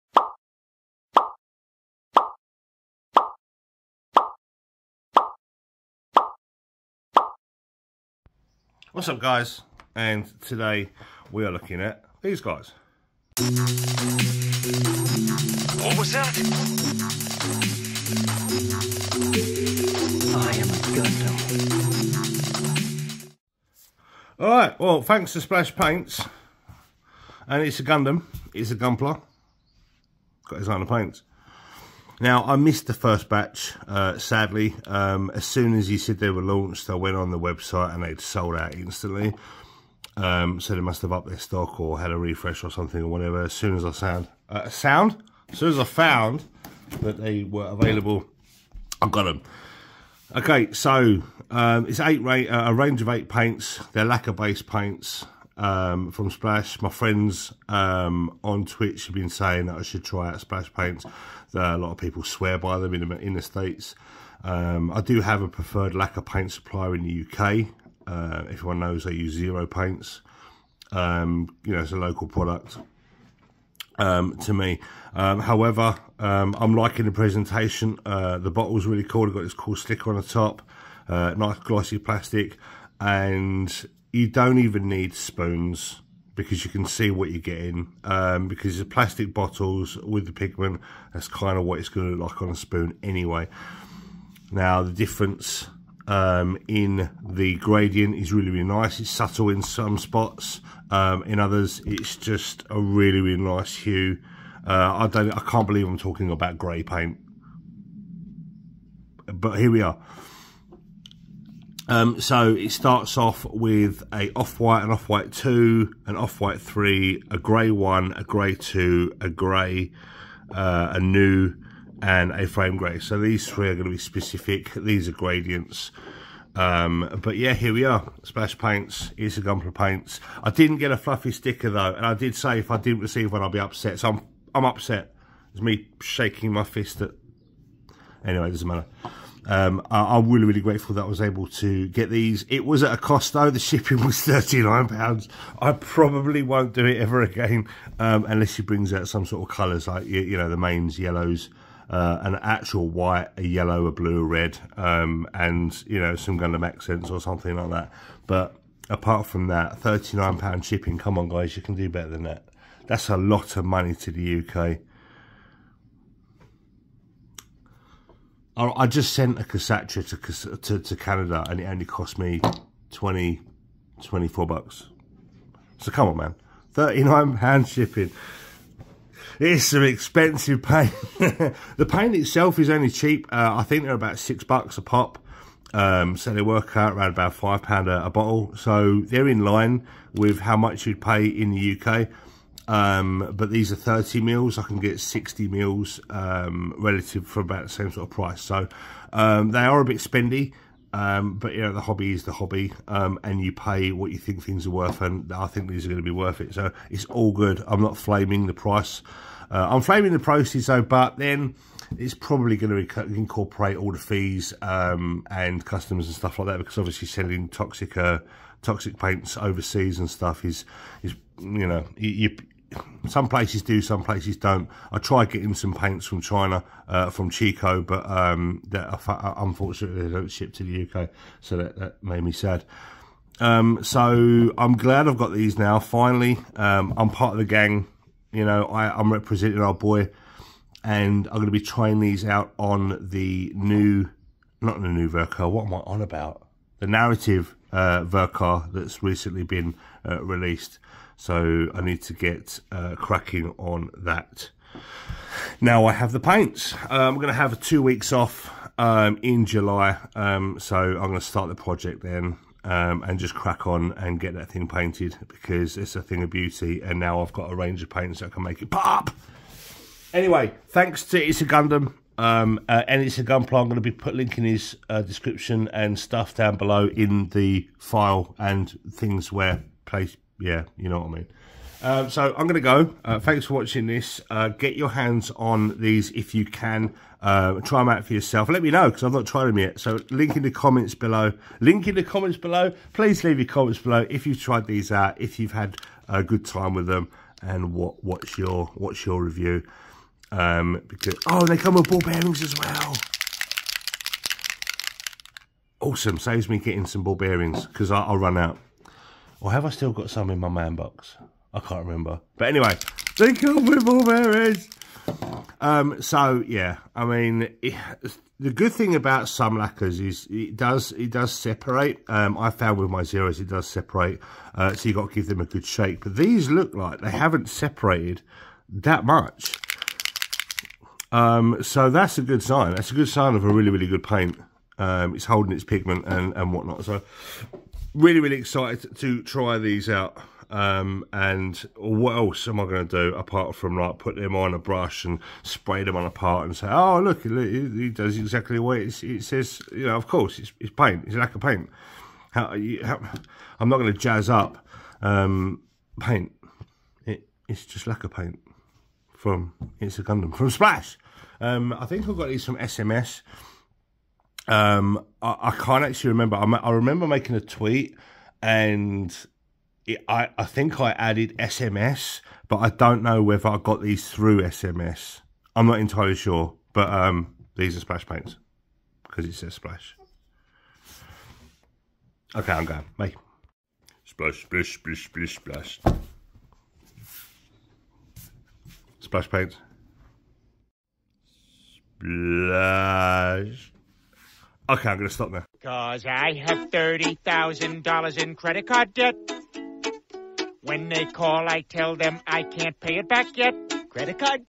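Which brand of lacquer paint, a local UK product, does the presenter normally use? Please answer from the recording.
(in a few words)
Zero Paints.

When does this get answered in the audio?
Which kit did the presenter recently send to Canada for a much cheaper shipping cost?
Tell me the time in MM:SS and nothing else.
02:49.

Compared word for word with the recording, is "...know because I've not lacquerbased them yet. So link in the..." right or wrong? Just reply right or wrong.
wrong.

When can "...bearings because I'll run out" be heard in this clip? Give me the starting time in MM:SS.
05:07.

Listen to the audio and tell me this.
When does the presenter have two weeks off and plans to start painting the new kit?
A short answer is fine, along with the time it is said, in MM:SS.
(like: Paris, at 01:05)
July, at 04:19.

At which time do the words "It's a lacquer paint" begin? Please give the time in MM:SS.
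05:51.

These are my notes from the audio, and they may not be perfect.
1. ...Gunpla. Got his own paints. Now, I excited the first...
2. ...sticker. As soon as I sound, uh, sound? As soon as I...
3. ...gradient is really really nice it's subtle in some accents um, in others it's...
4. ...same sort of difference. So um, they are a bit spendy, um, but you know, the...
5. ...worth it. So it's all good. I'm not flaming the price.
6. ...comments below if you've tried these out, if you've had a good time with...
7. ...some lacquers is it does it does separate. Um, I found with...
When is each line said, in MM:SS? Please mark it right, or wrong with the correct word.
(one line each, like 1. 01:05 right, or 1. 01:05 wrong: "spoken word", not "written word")
1. 00:28 wrong: "missed", not "excited"
2. 00:43 wrong: "whatever", not "sticker"
3. 01:37 wrong: "spots", not "accents"
4. 03:17 wrong: "price", not "difference"
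5. 03:26 right
6. 04:53 right
7. 05:19 right.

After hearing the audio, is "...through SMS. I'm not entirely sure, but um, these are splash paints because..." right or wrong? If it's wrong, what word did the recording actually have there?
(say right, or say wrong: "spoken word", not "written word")
right.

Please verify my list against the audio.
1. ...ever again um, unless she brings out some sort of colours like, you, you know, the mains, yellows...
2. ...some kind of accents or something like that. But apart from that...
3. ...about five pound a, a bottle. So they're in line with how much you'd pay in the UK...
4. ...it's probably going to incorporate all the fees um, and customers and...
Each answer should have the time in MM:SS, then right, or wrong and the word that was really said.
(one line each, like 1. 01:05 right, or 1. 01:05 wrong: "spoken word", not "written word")
1. 02:26 right
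2. 02:36 right
3. 03:07 right
4. 03:31 right.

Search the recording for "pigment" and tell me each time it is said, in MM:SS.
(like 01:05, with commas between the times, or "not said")
01:30, 05:35.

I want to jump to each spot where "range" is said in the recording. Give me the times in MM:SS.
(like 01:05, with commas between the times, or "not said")
00:52, 04:27.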